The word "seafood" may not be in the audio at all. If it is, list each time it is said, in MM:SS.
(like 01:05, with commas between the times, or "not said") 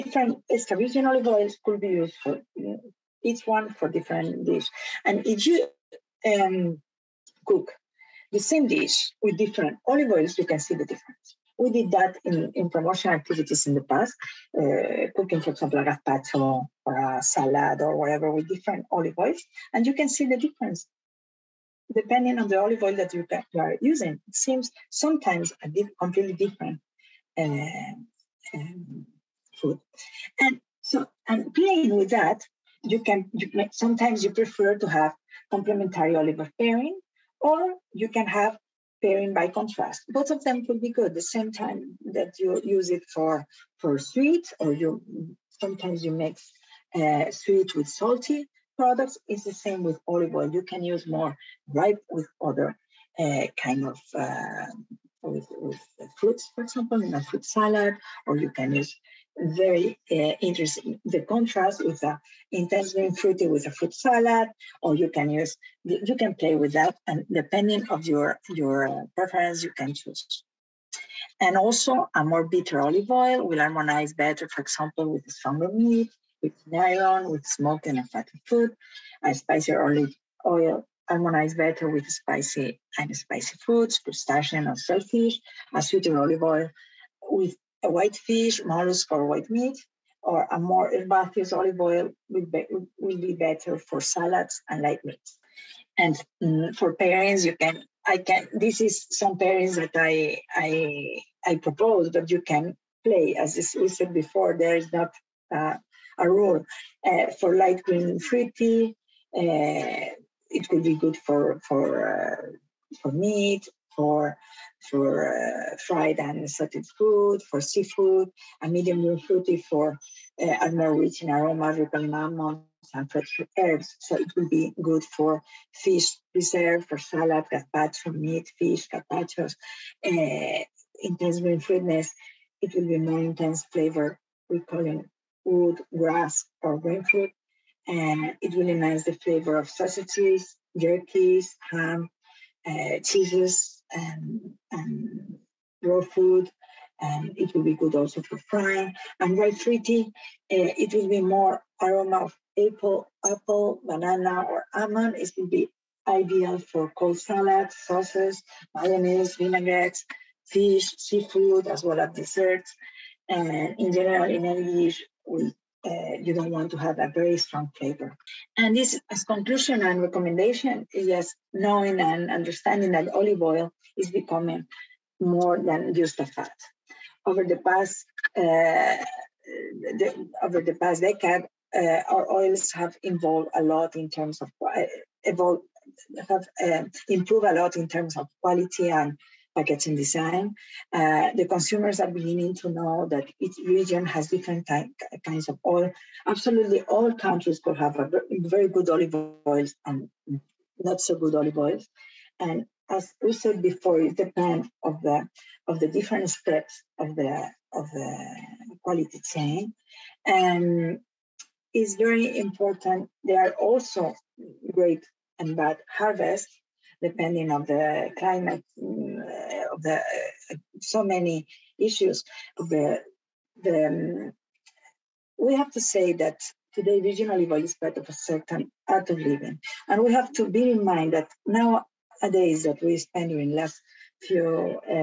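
01:57, 02:40.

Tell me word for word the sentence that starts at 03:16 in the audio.
Absolutely, all countries could have a very good olive oils and not so good olive oils.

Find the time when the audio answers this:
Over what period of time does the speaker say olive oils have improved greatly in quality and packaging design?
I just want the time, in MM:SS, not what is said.
03:00.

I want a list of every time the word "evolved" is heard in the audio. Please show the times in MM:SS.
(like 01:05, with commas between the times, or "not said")
03:03.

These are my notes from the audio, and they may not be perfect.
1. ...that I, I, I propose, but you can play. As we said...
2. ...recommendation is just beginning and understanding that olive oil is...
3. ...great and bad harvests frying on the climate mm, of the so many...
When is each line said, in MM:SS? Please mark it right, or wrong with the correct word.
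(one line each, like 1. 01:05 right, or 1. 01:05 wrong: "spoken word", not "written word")
1. 01:39 right
2. 02:50 wrong: "knowing", not "beginning"
3. 03:34 wrong: "depending", not "frying".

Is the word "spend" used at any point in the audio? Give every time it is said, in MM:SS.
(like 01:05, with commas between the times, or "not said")
03:53.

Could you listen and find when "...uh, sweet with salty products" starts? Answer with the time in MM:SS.
00:46.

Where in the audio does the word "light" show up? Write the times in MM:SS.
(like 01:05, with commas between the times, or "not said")
01:34, 01:47.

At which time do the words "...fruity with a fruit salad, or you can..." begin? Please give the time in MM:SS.
01:03.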